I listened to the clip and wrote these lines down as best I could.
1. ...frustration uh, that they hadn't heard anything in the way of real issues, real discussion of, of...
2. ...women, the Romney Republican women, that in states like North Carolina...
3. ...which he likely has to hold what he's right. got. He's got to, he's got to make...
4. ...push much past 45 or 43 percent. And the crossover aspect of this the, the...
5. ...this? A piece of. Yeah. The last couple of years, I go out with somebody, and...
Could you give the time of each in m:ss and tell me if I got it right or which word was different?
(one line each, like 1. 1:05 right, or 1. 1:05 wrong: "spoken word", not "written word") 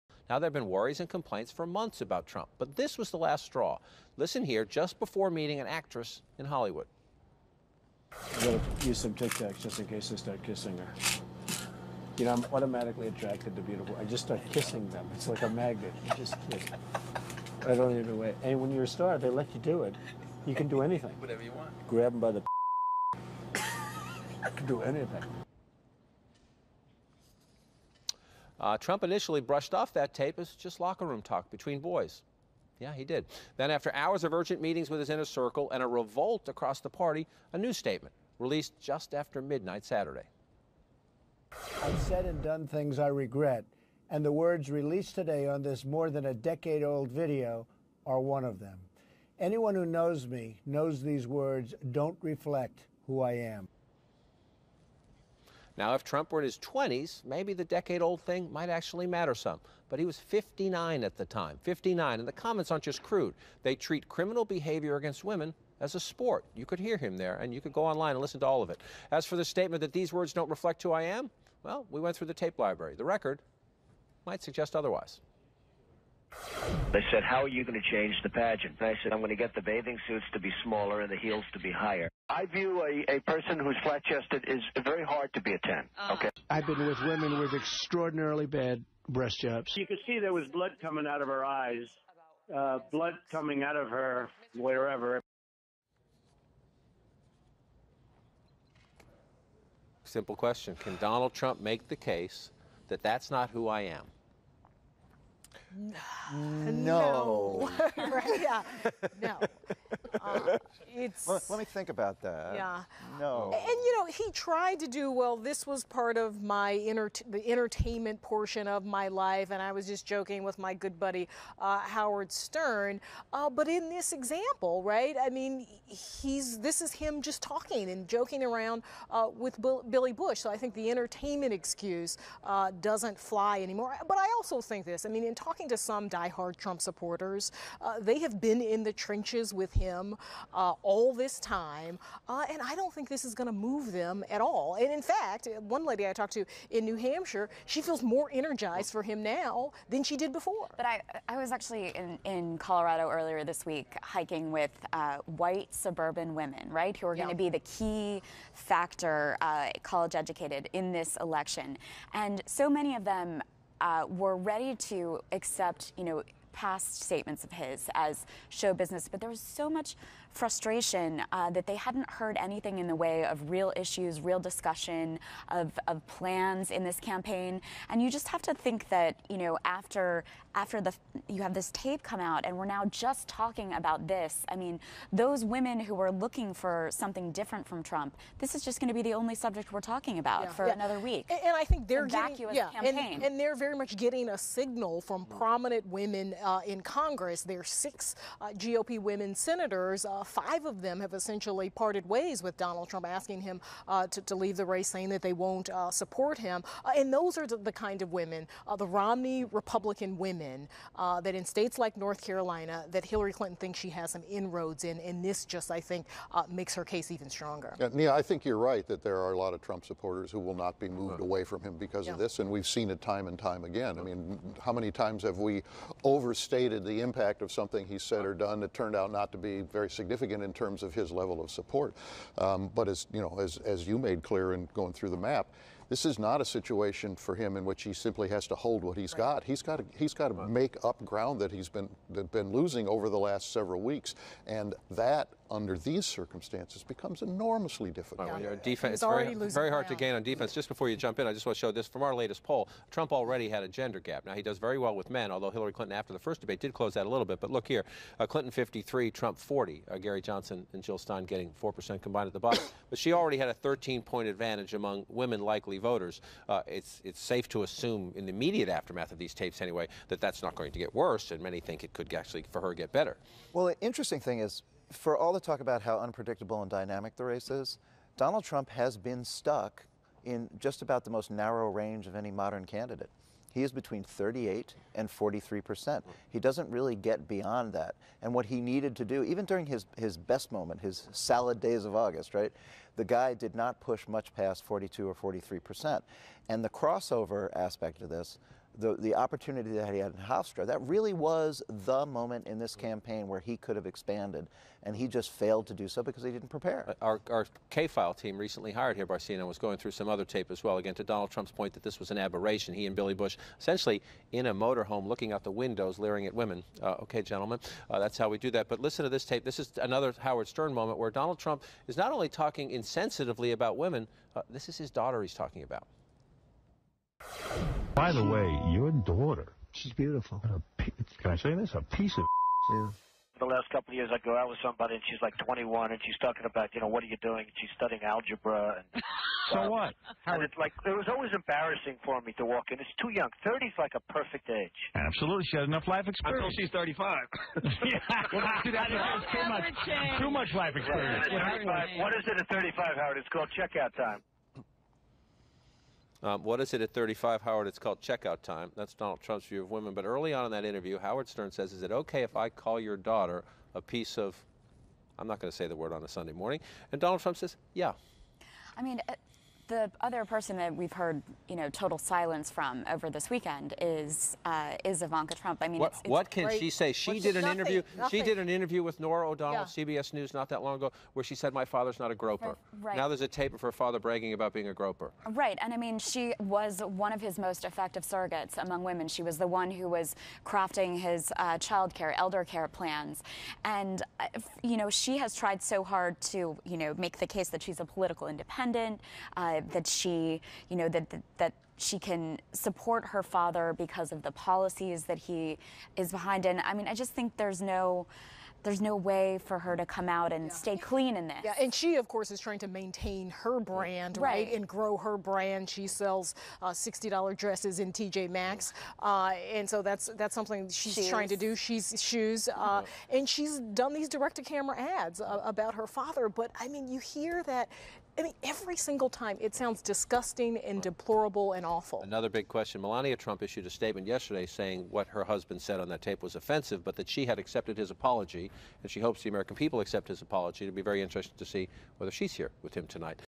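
1. 2:50 right
2. 3:28 right
3. 3:57 wrong: "simply", not "likely"
4. 4:53 wrong: "42", not "45"
5. 5:31 right.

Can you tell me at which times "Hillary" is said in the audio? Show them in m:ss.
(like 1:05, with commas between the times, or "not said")
3:33, 4:15.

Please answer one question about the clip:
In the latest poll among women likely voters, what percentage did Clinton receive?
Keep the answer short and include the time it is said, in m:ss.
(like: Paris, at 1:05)
53, at 4:18.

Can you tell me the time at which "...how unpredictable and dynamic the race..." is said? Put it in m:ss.
4:35.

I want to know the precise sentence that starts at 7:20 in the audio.
It'll be very interesting to see whether she's here with him tonight.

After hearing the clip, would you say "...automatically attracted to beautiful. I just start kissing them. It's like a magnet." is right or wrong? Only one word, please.
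right.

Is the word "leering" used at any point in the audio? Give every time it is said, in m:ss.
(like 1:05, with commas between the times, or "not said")
5:15.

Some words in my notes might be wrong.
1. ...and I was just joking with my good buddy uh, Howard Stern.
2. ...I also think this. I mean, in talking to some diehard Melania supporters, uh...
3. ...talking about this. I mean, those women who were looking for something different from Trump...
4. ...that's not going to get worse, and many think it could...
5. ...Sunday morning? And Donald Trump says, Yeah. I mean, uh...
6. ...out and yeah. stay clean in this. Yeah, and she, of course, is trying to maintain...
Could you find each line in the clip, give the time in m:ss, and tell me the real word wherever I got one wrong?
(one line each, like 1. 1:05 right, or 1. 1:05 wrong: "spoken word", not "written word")
1. 1:59 right
2. 2:14 wrong: "Trump", not "Melania"
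3. 3:03 right
4. 4:30 right
5. 6:06 right
6. 6:50 right.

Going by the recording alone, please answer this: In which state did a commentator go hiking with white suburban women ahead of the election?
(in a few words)
Colorado.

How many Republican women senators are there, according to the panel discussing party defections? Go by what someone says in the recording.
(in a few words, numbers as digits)
6.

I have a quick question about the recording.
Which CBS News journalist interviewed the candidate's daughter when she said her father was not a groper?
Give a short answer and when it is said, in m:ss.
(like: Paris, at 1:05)
Norah O'Donnell, at 6:18.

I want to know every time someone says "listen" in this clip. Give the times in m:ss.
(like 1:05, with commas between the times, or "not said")
0:04, 1:08, 5:18.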